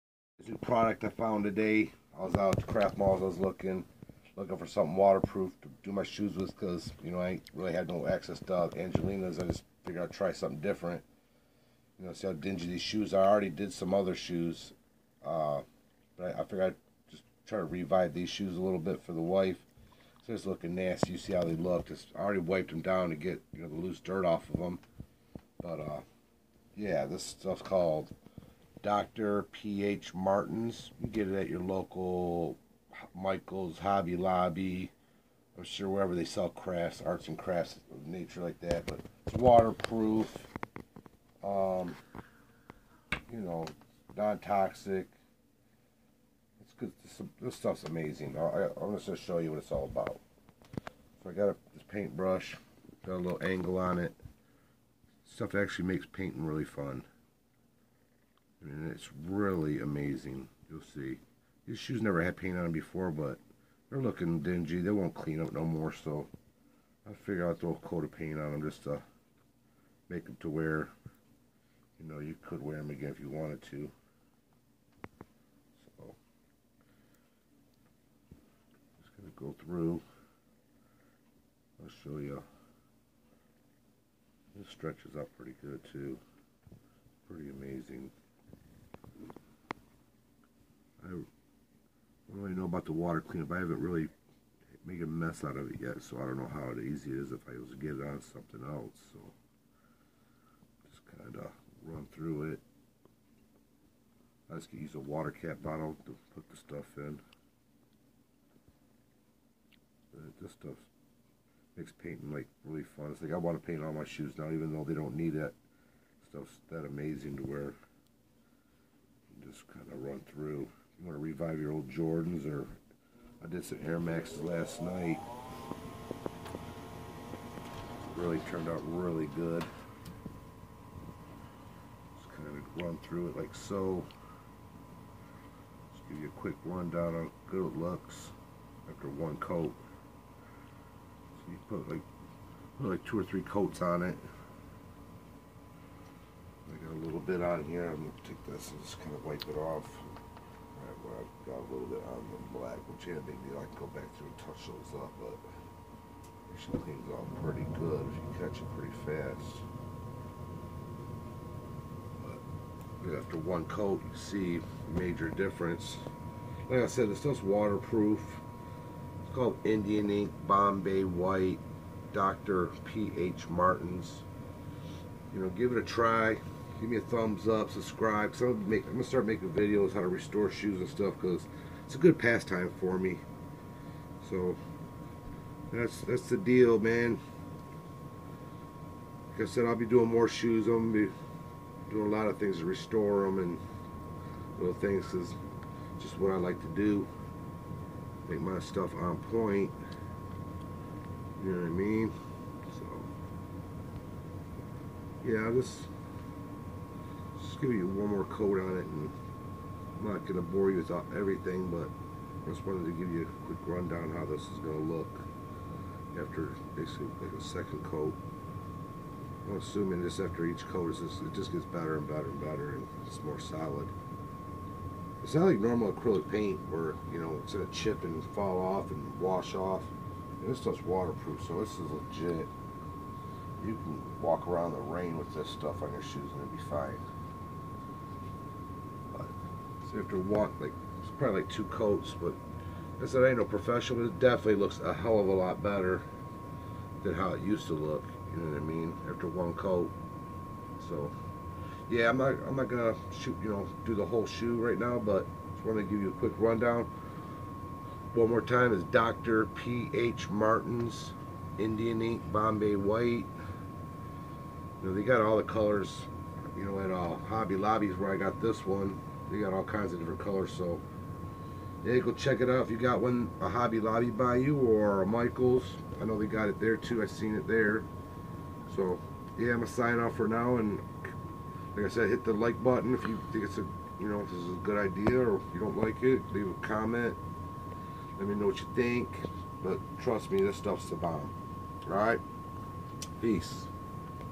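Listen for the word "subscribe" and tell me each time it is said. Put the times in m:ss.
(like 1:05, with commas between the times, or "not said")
2:57.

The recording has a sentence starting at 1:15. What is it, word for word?
So, just going to go through.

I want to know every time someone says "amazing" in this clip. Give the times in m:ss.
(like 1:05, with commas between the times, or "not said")
0:47, 0:59, 1:27, 1:56.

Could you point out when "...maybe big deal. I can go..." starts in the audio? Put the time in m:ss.
2:33.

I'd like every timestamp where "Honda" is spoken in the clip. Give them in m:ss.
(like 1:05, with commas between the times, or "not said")
not said.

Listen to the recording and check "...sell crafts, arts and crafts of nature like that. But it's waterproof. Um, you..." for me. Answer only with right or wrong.
right.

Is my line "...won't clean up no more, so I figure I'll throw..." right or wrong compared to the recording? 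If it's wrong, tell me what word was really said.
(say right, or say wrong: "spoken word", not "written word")
right.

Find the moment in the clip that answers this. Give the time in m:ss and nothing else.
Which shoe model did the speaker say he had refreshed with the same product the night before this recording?
2:03.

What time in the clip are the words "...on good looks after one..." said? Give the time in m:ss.
2:17.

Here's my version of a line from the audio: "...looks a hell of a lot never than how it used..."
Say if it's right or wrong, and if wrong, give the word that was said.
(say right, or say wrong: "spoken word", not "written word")
wrong: "better", not "never".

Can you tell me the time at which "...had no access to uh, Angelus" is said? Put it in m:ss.
0:07.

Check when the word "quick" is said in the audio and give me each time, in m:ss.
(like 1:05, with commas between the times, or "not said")
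2:16, 3:33, 4:16.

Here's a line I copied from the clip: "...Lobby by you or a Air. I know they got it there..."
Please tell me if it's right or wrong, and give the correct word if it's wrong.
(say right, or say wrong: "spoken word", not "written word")
wrong: "Michaels", not "Air".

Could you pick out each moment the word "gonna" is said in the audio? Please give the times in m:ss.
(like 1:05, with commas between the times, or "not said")
0:49, 2:27, 2:58, 3:10, 3:47, 4:12, 4:39.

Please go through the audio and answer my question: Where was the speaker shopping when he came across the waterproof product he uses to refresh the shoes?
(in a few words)
Craft Malls.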